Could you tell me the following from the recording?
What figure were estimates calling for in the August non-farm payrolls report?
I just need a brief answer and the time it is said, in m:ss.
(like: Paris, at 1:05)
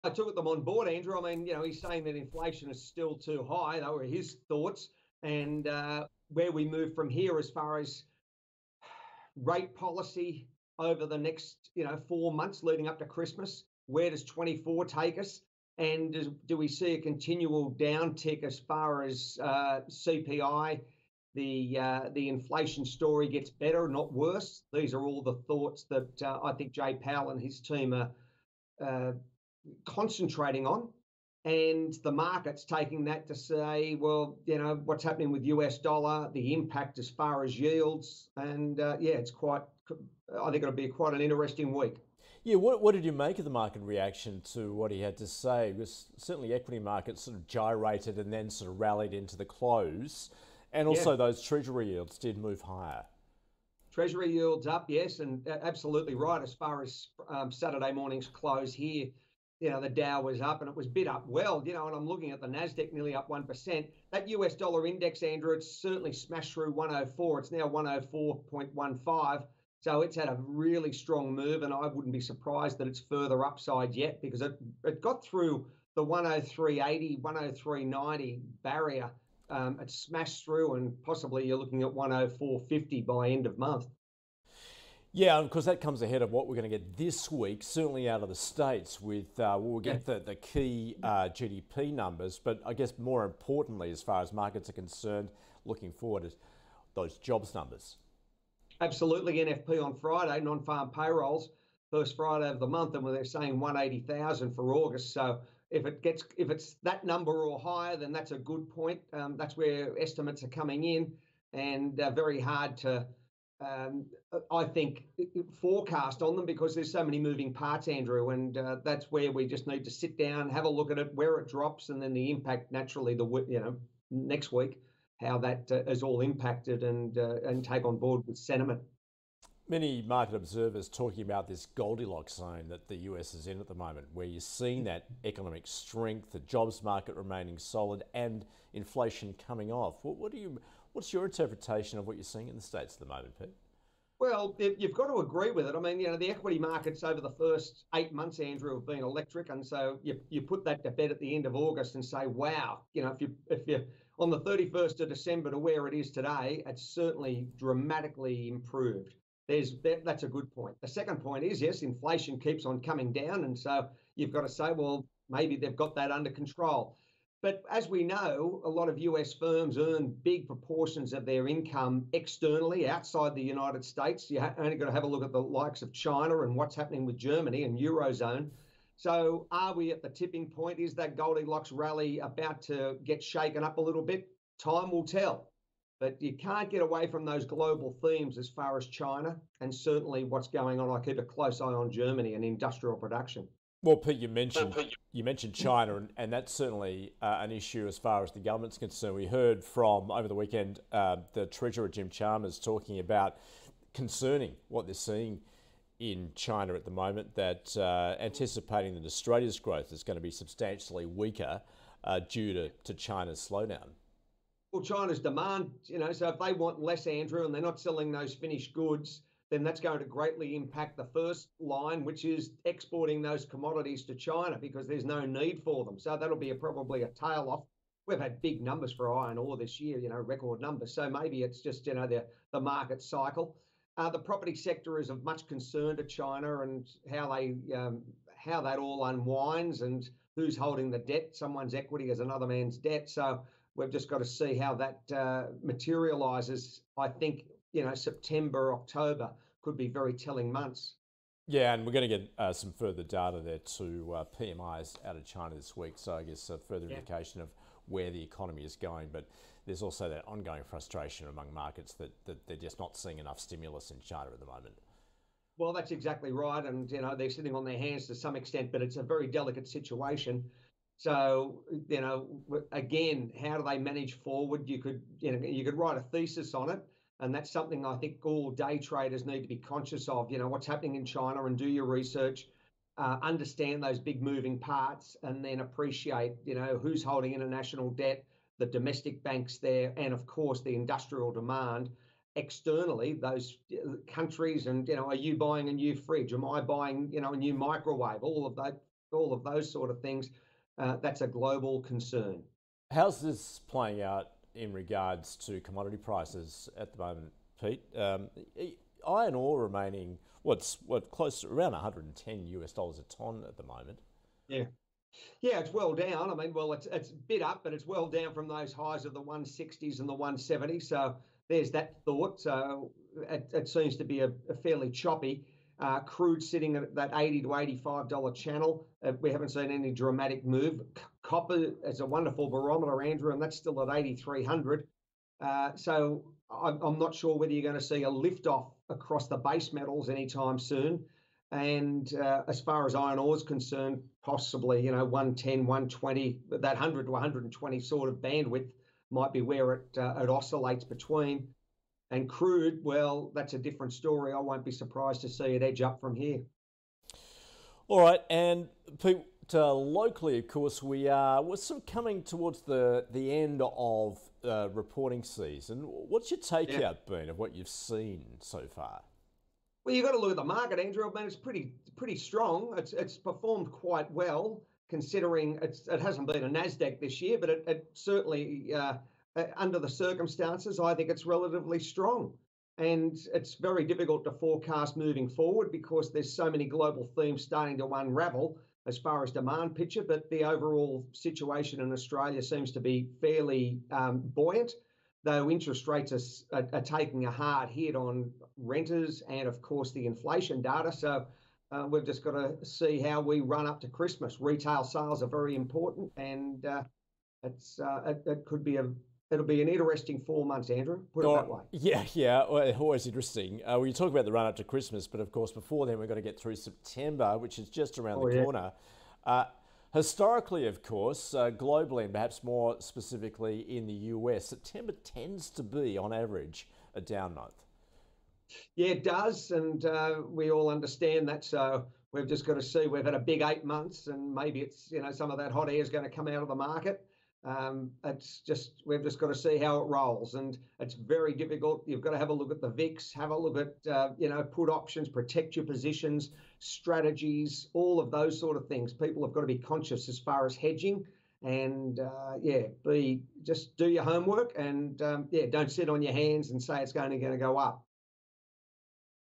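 180,000, at 1:43.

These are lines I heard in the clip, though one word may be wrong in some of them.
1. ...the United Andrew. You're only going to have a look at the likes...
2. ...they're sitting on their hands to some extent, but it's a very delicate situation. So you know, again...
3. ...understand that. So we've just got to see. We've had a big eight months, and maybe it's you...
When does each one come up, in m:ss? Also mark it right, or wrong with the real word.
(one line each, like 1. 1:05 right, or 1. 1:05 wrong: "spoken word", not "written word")
1. 2:53 wrong: "States", not "Andrew"
2. 4:27 right
3. 7:10 right.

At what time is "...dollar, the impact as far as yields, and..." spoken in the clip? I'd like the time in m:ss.
0:35.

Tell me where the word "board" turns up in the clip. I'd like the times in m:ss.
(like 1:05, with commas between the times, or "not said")
0:00, 2:07.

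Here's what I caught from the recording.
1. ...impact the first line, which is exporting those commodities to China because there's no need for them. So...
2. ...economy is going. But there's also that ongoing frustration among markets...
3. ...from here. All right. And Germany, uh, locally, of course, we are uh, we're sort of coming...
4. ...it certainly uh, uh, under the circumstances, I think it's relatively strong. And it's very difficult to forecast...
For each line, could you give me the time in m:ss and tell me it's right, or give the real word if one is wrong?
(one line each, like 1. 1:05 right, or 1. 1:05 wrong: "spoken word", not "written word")
1. 3:40 right
2. 4:18 right
3. 5:56 wrong: "Pete", not "Germany"
4. 6:17 right.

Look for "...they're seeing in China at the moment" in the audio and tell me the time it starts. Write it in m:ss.
3:24.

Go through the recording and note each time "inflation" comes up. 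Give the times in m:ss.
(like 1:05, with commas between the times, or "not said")
0:02, 0:22, 2:18, 2:41, 6:40.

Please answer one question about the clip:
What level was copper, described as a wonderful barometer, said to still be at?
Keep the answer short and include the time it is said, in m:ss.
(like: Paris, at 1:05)
8,300, at 5:33.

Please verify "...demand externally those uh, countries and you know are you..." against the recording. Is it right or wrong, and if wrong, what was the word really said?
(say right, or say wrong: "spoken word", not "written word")
right.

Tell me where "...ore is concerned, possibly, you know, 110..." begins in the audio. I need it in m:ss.
5:43.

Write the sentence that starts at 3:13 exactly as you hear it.
Well, Pete, you mentioned you mentioned China, and, and that's certainly uh, an issue as far as the government's concerned.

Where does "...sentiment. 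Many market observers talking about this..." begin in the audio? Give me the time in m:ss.
2:08.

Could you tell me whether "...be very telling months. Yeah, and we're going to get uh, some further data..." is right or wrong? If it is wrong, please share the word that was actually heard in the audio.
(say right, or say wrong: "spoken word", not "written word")
right.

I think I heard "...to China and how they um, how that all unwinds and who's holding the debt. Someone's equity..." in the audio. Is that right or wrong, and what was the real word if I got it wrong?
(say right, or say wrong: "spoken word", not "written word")
right.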